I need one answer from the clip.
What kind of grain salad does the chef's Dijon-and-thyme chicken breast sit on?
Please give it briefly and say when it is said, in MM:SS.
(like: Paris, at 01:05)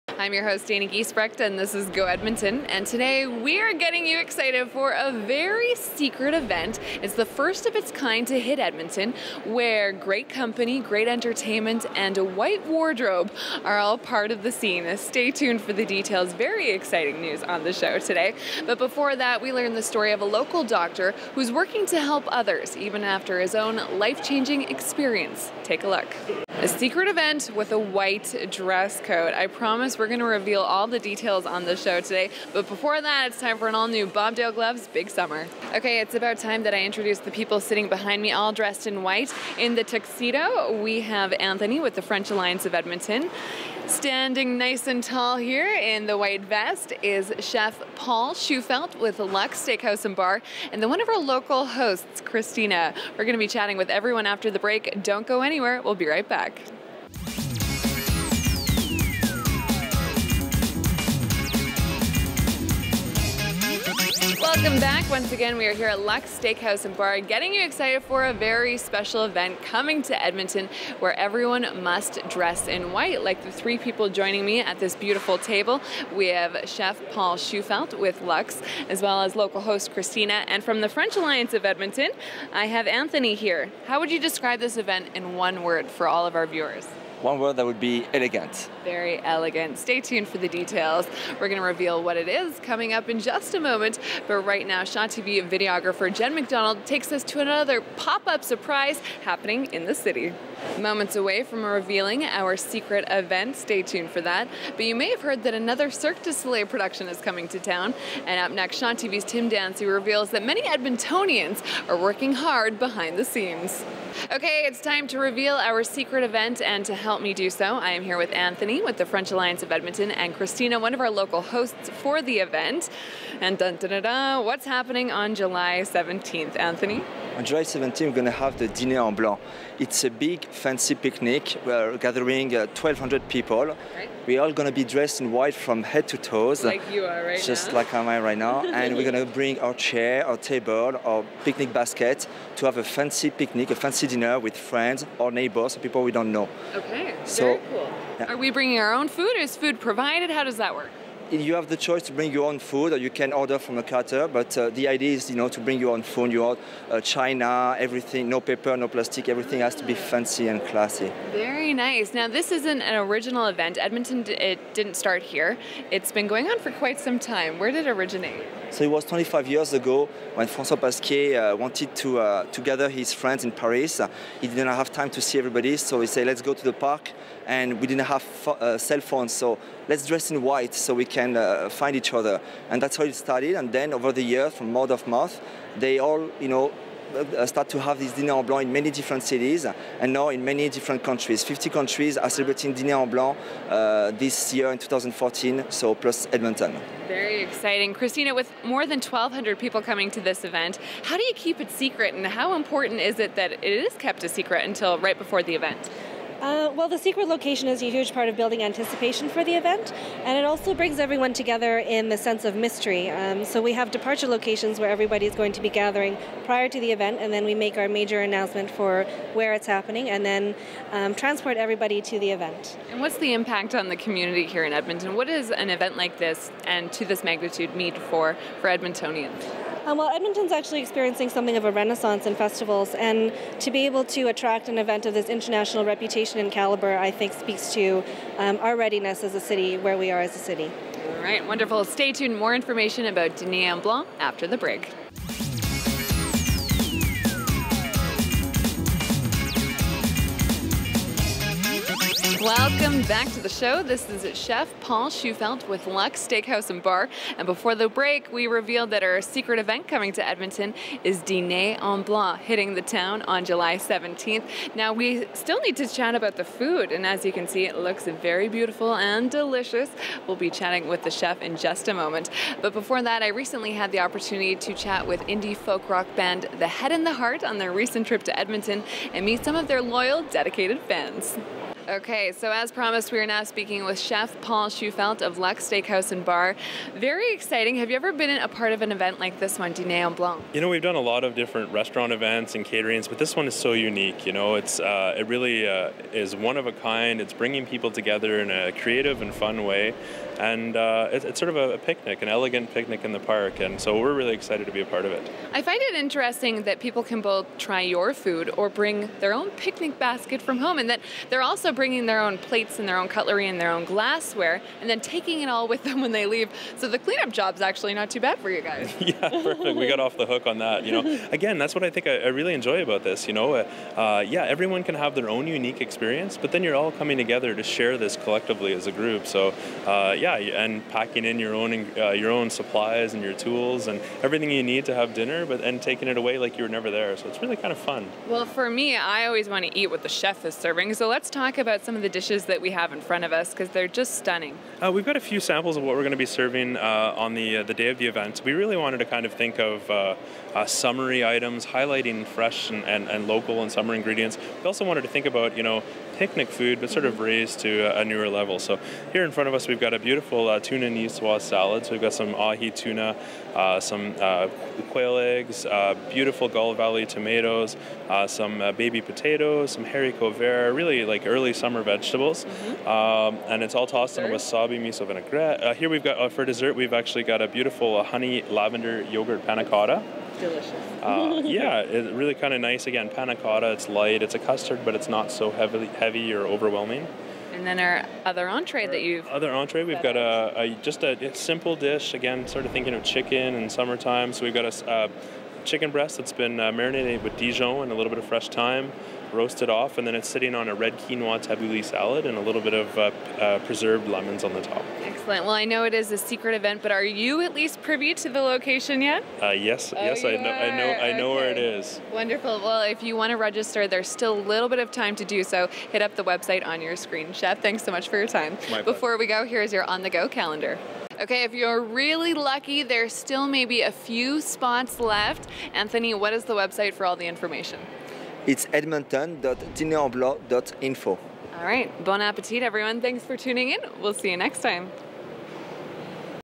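Red quinoa tabbouleh, at 06:40.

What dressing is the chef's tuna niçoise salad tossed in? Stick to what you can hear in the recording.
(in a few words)
Wasabi miso vinaigrette.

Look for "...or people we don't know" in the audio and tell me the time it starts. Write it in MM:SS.
02:25.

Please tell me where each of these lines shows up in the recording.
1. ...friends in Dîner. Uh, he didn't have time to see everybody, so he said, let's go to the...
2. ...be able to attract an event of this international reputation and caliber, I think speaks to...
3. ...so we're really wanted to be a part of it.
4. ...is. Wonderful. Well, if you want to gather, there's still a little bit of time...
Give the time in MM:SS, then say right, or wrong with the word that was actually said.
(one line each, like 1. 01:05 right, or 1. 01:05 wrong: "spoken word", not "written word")
1. 02:53 wrong: "Paris", not "Dîner"
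2. 03:53 right
3. 05:03 wrong: "excited", not "wanted"
4. 06:51 wrong: "register", not "gather".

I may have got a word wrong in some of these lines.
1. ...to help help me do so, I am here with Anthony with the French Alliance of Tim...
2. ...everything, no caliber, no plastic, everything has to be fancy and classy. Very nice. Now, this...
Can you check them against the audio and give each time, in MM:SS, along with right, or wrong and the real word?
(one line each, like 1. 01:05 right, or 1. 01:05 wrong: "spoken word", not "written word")
1. 01:56 wrong: "Edmonton", not "Tim"
2. 02:37 wrong: "paper", not "caliber".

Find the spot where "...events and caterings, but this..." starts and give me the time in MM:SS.
04:52.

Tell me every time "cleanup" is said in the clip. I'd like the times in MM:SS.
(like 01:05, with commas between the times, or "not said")
05:16.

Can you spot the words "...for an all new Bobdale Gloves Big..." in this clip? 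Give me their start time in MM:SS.
00:33.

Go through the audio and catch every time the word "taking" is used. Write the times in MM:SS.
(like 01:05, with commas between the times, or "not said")
05:14, 05:35.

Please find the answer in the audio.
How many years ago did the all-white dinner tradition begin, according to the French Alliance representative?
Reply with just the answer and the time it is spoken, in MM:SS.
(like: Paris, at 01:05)
25, at 02:49.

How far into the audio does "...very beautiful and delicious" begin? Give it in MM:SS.
04:28.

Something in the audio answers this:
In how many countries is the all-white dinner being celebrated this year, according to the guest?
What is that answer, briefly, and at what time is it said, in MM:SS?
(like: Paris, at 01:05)
50, at 03:11.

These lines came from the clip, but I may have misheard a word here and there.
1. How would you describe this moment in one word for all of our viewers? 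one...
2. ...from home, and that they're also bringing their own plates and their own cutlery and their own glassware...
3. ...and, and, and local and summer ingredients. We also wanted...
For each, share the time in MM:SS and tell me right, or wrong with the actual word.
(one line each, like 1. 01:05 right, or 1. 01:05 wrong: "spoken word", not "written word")
1. 01:23 wrong: "event", not "moment"
2. 05:10 right
3. 05:52 right.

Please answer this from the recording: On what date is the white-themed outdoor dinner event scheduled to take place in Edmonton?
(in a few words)
July 17.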